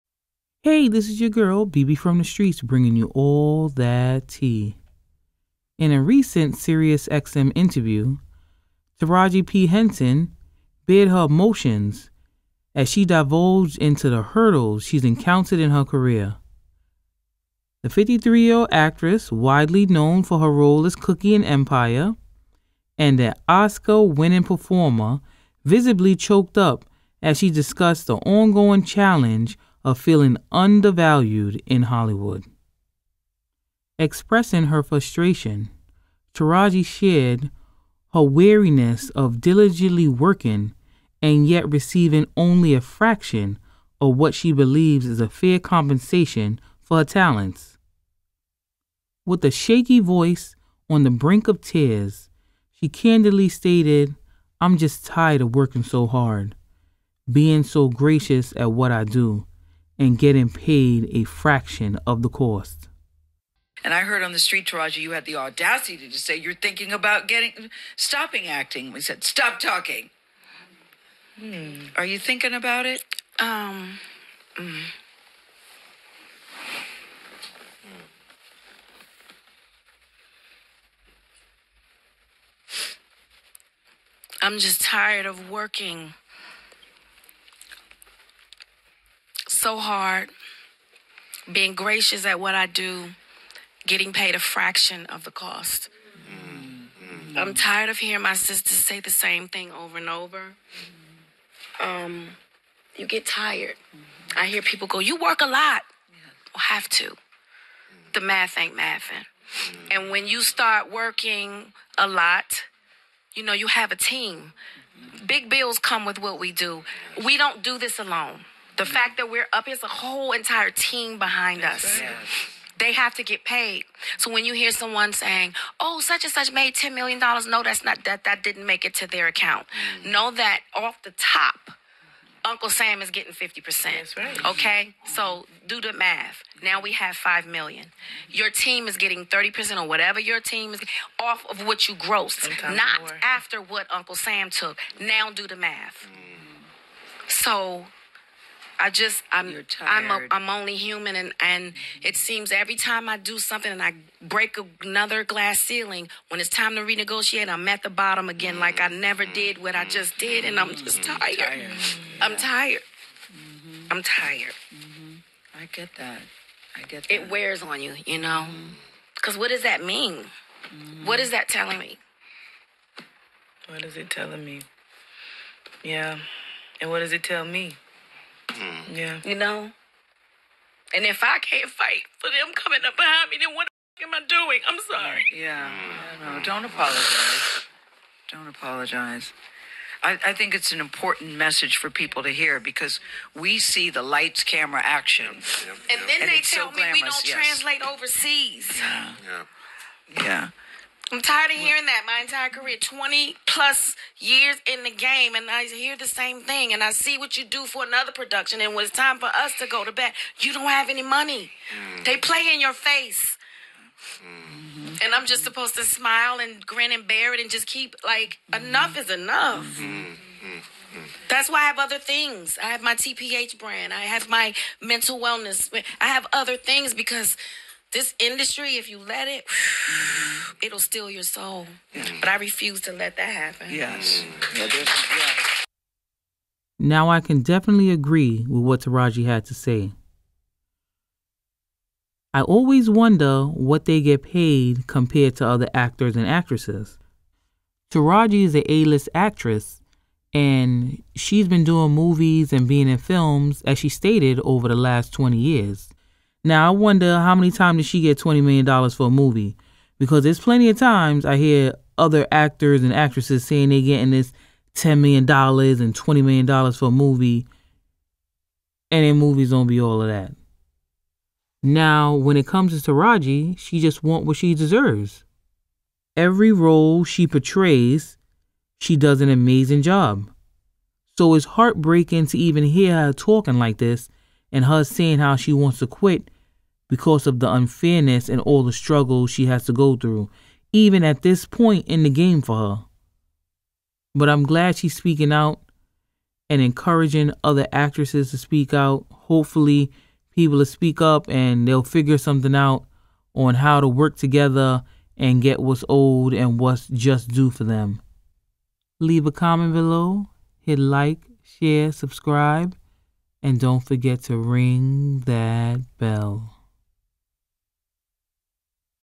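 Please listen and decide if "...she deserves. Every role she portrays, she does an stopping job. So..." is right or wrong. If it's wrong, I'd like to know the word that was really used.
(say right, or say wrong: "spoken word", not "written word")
wrong: "amazing", not "stopping".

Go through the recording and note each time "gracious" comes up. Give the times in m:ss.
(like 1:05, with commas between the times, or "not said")
0:57, 1:31.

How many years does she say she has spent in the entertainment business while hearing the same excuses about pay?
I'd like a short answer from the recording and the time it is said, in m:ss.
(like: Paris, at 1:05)
20 plus years, at 3:22.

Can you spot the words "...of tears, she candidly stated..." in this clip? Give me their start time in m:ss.
0:51.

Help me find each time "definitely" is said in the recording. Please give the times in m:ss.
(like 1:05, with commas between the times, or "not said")
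3:57.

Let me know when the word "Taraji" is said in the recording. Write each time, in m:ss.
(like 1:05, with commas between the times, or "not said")
0:08, 0:36, 1:04, 3:58, 4:07, 4:32.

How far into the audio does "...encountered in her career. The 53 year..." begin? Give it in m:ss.
0:15.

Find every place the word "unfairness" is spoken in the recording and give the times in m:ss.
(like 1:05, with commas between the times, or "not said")
4:47.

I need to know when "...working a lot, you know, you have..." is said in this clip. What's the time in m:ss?
1:50.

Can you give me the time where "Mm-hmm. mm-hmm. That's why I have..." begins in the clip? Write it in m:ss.
3:39.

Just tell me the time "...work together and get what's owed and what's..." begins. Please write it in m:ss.
5:03.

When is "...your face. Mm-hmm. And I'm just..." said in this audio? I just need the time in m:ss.
3:32.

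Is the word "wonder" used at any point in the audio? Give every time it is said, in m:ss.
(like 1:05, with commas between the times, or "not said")
4:02, 4:16.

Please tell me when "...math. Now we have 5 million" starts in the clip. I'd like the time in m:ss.
2:15.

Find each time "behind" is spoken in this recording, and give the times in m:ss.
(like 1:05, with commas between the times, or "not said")
2:01, 3:02.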